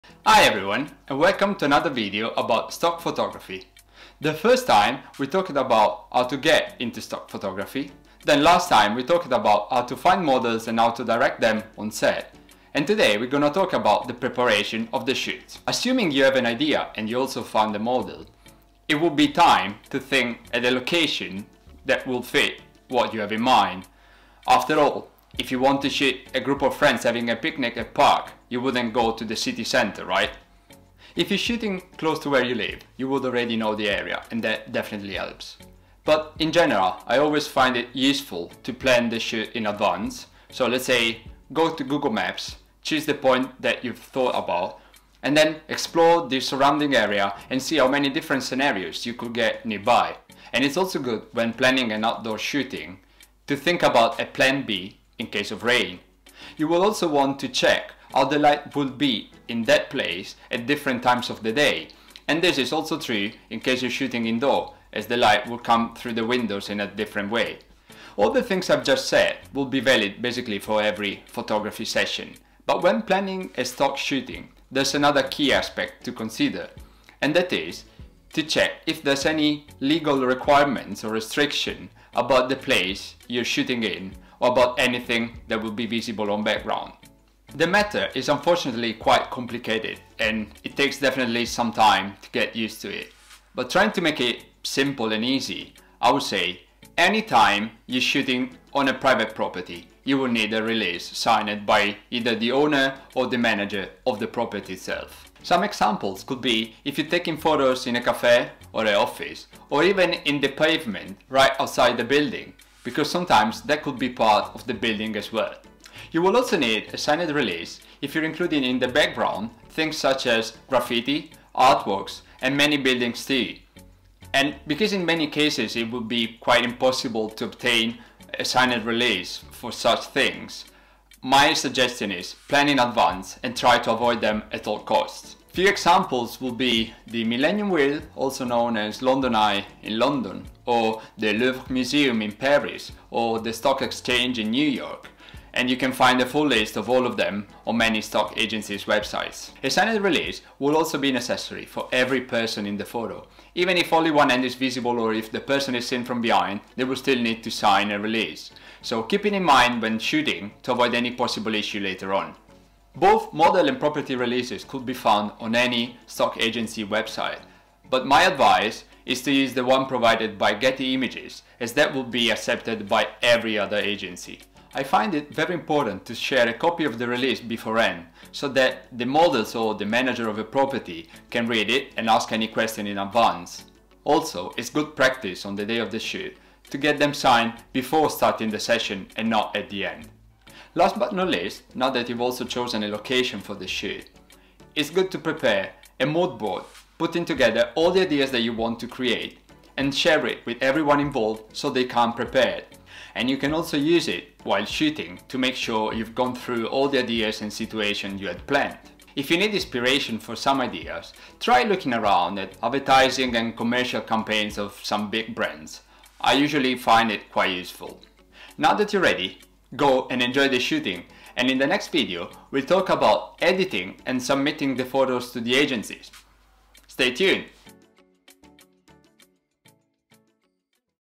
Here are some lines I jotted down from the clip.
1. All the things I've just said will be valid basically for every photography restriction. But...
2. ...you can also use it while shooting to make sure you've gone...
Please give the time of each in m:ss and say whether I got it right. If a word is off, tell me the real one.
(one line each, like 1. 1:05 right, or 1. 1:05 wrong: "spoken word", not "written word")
1. 1:08 wrong: "session", not "restriction"
2. 3:23 right.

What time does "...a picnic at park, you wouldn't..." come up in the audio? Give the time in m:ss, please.
0:27.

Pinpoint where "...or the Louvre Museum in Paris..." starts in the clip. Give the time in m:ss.
2:20.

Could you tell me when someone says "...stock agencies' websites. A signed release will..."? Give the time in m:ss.
2:27.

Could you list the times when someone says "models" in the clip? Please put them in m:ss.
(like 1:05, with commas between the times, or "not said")
0:10, 0:17, 2:43, 2:59.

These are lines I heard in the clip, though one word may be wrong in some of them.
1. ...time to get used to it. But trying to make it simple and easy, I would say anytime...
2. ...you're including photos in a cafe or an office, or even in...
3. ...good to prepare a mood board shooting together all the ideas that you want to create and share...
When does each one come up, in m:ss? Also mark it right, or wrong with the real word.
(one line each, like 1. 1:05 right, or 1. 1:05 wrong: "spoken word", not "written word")
1. 1:31 right
2. 1:46 wrong: "taking", not "including"
3. 3:14 wrong: "putting", not "shooting".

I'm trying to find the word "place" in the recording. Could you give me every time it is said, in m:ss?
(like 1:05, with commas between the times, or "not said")
0:59, 1:22.